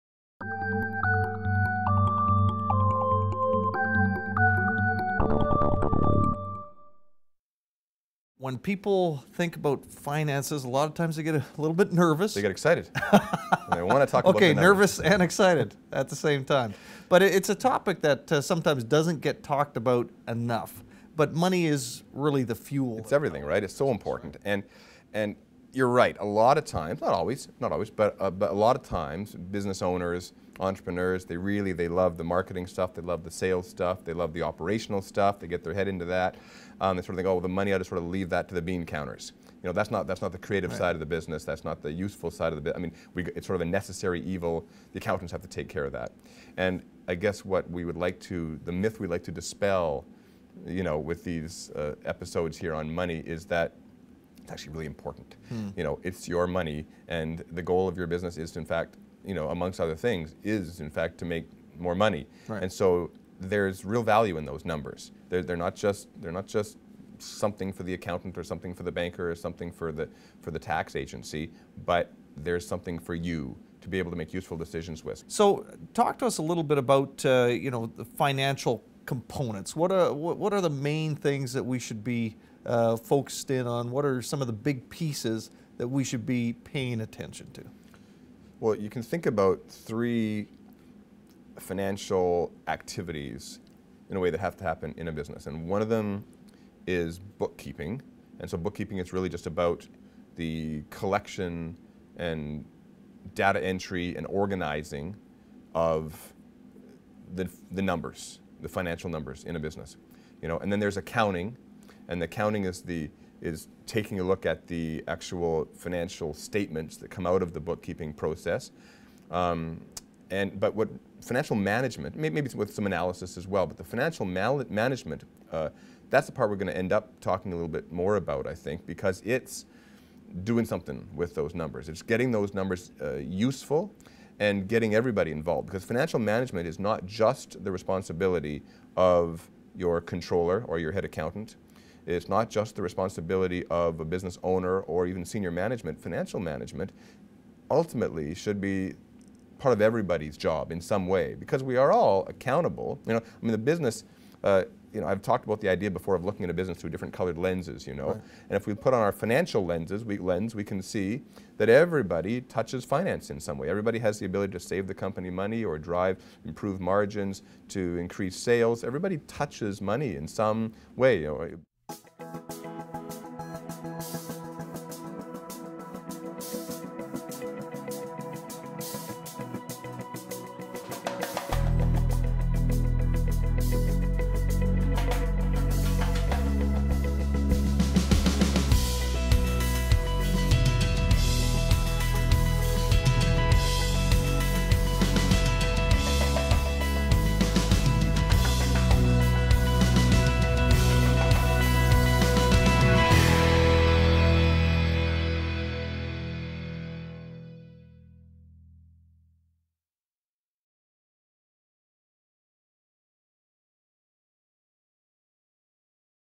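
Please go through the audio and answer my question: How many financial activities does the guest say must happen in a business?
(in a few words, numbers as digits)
3.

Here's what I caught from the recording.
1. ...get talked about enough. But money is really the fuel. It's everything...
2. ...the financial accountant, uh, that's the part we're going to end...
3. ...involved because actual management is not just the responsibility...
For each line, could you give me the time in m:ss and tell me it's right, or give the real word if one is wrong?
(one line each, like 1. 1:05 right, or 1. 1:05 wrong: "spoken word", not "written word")
1. 0:19 right
2. 2:03 wrong: "management", not "accountant"
3. 2:15 wrong: "financial", not "actual".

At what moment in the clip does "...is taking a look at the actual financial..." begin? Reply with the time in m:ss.
1:53.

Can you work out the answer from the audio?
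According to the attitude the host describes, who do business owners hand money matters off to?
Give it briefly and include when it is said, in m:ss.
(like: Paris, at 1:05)
bean counters, at 0:38.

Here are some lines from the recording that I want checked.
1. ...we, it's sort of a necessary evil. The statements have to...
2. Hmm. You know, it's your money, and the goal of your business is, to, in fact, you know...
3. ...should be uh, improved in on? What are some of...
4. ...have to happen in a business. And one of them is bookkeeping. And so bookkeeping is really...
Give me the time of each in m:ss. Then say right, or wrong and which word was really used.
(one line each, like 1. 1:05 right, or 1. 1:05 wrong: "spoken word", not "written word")
1. 0:43 wrong: "accountants", not "statements"
2. 0:55 right
3. 1:21 wrong: "focused", not "improved"
4. 1:34 right.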